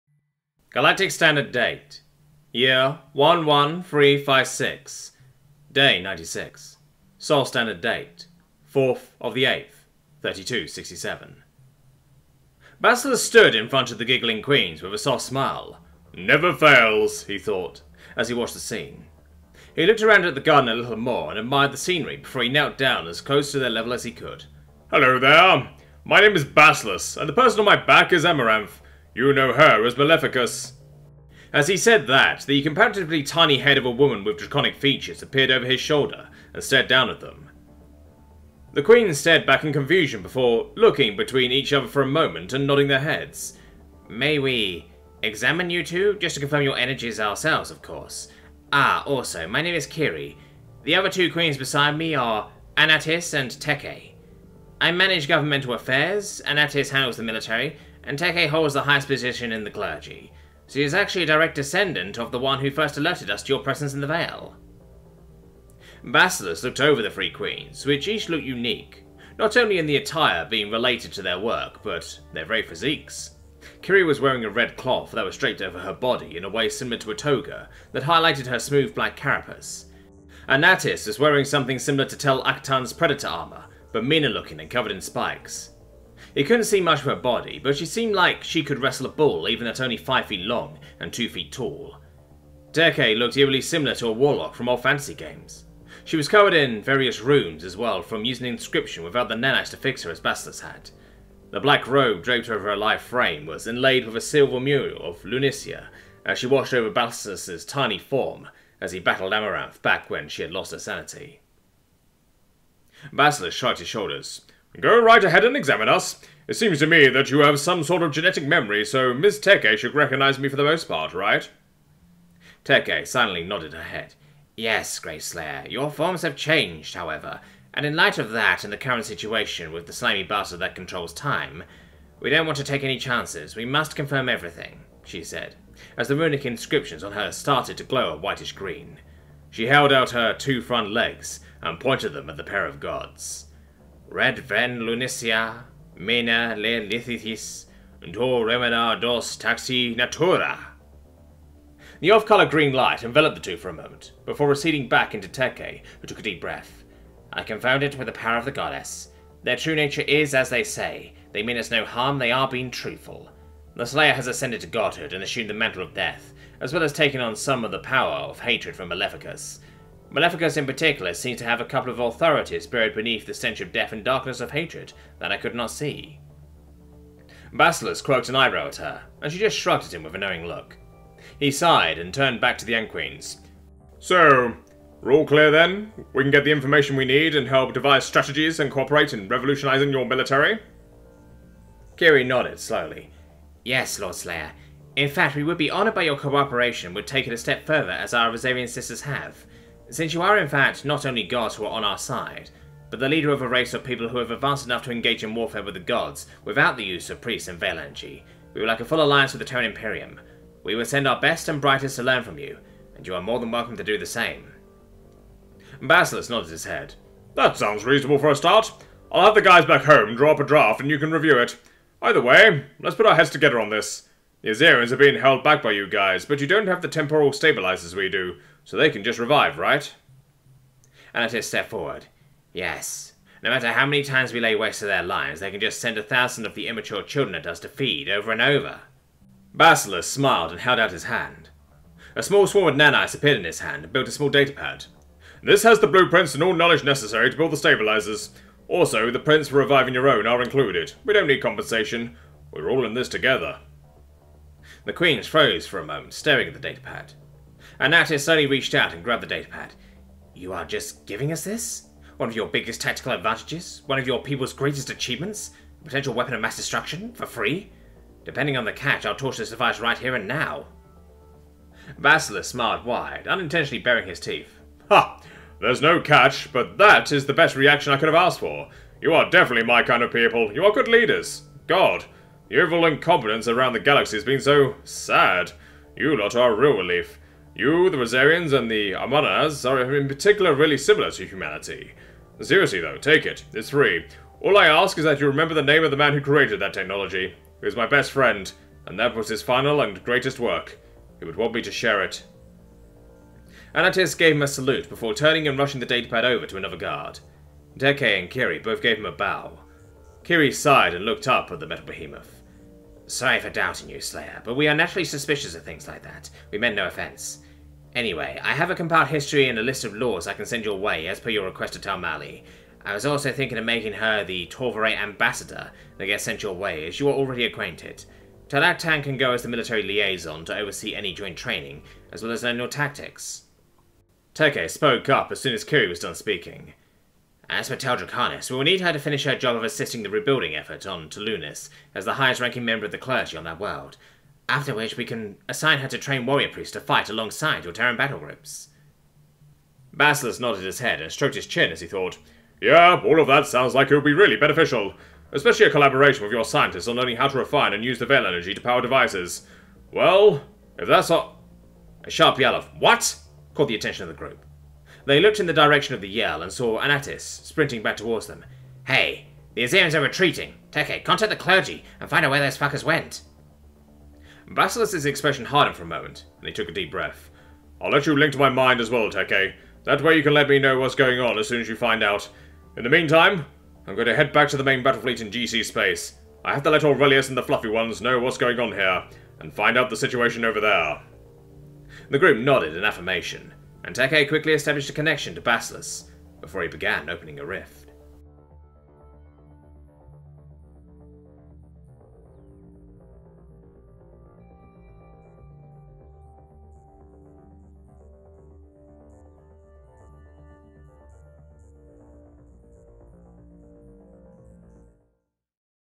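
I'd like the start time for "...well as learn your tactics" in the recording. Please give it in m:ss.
5:32.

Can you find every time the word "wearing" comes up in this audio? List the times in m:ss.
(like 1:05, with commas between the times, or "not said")
1:14, 1:21.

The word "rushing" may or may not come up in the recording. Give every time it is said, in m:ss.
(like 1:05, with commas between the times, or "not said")
5:05.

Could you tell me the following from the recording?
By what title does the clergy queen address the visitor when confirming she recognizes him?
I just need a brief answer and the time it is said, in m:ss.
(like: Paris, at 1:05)
Grayslayer, at 2:04.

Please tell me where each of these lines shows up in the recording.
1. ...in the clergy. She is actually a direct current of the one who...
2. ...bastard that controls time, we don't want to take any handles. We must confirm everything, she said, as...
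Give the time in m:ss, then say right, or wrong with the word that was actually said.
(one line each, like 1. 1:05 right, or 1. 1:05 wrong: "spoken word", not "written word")
1. 0:59 wrong: "descendant", not "current"
2. 2:10 wrong: "chances", not "handles".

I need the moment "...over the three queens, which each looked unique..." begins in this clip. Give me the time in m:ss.
1:06.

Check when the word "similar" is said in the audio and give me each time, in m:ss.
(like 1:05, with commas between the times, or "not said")
1:16, 1:21, 1:33, 4:50.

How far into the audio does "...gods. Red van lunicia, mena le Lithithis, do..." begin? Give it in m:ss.
2:22.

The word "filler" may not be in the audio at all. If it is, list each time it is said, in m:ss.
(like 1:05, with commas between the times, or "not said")
not said.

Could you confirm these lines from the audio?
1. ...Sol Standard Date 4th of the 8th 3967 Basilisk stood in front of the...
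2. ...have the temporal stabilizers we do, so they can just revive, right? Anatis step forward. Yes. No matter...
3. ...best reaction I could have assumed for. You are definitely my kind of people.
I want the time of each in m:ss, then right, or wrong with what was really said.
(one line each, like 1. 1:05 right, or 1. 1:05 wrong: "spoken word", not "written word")
1. 0:07 wrong: "3267", not "3967"
2. 3:46 right
3. 4:37 wrong: "asked", not "assumed".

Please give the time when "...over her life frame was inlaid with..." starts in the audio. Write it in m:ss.
1:42.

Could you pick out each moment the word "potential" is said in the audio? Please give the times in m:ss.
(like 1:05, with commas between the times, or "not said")
4:25.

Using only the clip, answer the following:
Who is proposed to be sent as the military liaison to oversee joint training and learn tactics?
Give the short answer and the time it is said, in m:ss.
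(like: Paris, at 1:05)
Talatan, at 5:28.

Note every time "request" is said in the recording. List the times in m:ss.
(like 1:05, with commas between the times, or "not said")
5:21.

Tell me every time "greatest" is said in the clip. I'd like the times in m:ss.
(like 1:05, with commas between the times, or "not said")
4:24, 5:00.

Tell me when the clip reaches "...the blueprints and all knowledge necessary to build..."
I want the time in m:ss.
4:05.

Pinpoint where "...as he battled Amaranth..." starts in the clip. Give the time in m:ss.
1:48.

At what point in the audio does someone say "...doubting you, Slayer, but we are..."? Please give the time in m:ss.
5:13.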